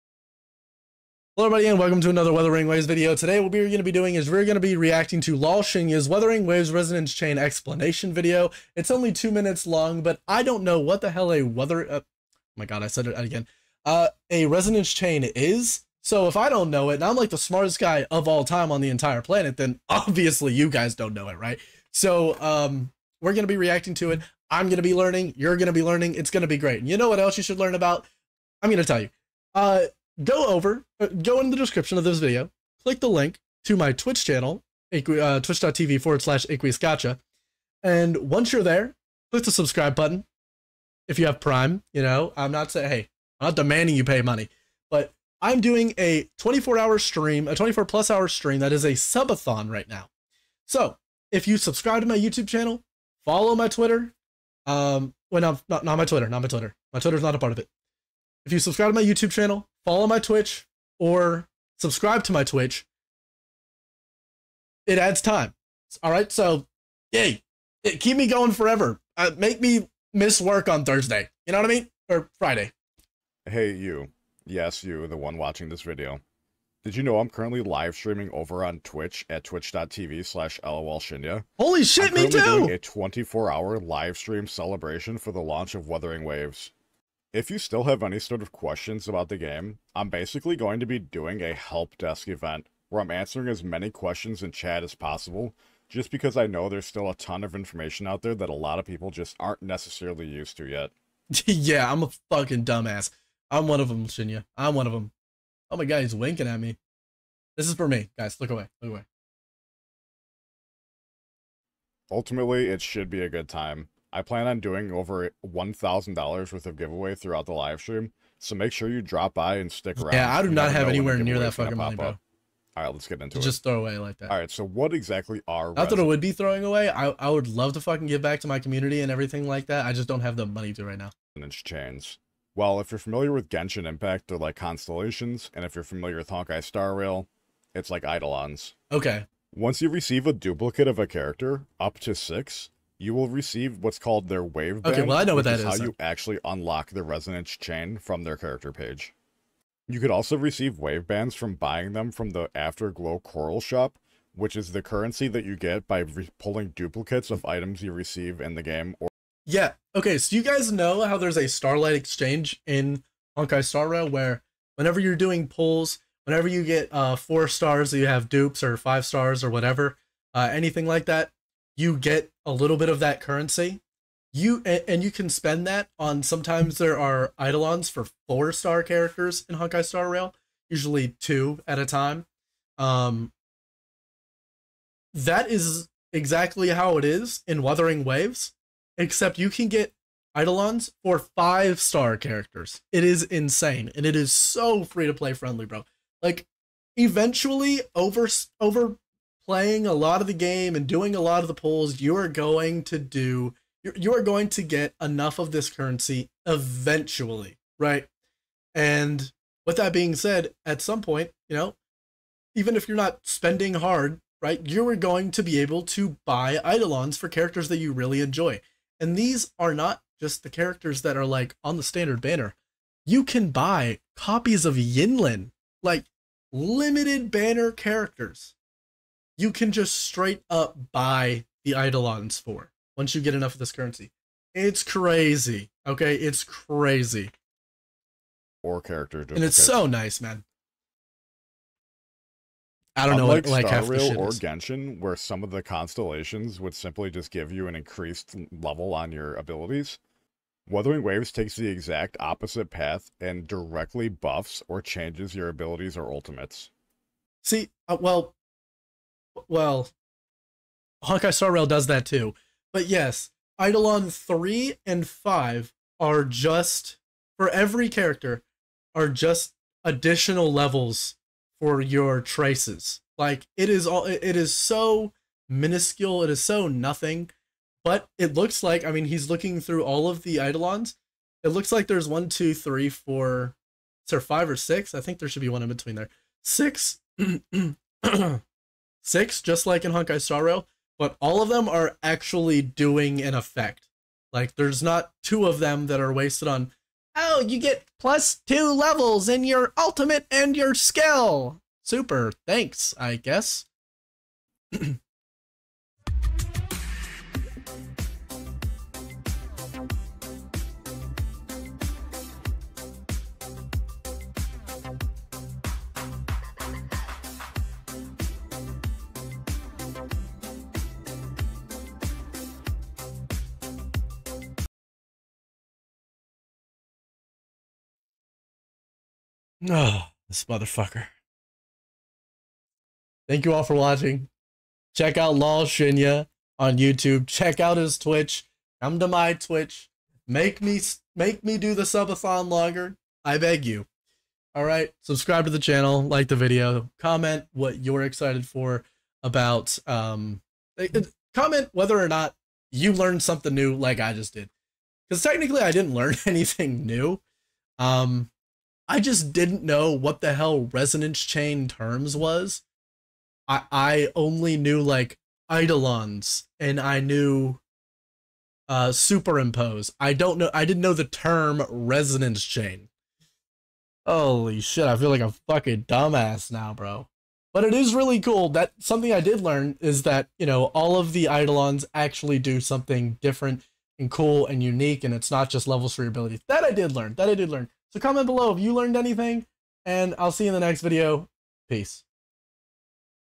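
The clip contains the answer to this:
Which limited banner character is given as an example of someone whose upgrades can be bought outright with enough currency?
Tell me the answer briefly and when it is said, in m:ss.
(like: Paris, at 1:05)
Yinlin, at 3:44.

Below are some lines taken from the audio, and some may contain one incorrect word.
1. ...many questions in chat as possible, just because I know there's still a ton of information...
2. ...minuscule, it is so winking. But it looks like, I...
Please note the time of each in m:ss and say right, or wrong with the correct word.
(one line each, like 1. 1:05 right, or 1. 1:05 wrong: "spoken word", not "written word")
1. 1:33 right
2. 4:35 wrong: "nothing", not "winking".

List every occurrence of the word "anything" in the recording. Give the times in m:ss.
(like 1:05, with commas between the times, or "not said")
2:50, 5:56, 6:28.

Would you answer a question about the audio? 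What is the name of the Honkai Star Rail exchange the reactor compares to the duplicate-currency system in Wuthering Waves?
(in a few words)
Starlight Exchange.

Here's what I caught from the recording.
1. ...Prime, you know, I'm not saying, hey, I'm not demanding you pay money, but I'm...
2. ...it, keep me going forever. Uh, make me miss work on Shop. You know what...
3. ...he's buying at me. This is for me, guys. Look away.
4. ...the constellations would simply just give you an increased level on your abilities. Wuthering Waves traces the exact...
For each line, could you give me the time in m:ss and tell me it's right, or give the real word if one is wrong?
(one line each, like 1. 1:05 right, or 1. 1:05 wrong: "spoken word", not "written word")
1. 0:41 right
2. 1:07 wrong: "Thursday", not "Shop"
3. 1:46 wrong: "winking", not "buying"
4. 4:05 wrong: "takes", not "traces".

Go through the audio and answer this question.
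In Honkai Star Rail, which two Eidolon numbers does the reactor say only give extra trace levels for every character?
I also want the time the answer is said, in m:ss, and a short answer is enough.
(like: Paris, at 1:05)
3 and 5, at 4:23.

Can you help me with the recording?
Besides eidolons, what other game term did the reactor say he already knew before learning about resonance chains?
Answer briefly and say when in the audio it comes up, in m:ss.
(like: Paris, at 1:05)
superimpose, at 6:08.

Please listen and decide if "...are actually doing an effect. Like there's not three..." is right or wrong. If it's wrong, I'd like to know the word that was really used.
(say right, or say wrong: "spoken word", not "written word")
wrong: "two", not "three".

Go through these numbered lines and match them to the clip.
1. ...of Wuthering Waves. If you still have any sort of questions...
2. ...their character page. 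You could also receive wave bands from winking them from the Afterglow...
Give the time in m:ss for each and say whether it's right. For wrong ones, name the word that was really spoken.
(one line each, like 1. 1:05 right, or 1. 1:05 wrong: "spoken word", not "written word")
1. 1:25 right
2. 2:28 wrong: "buying", not "winking".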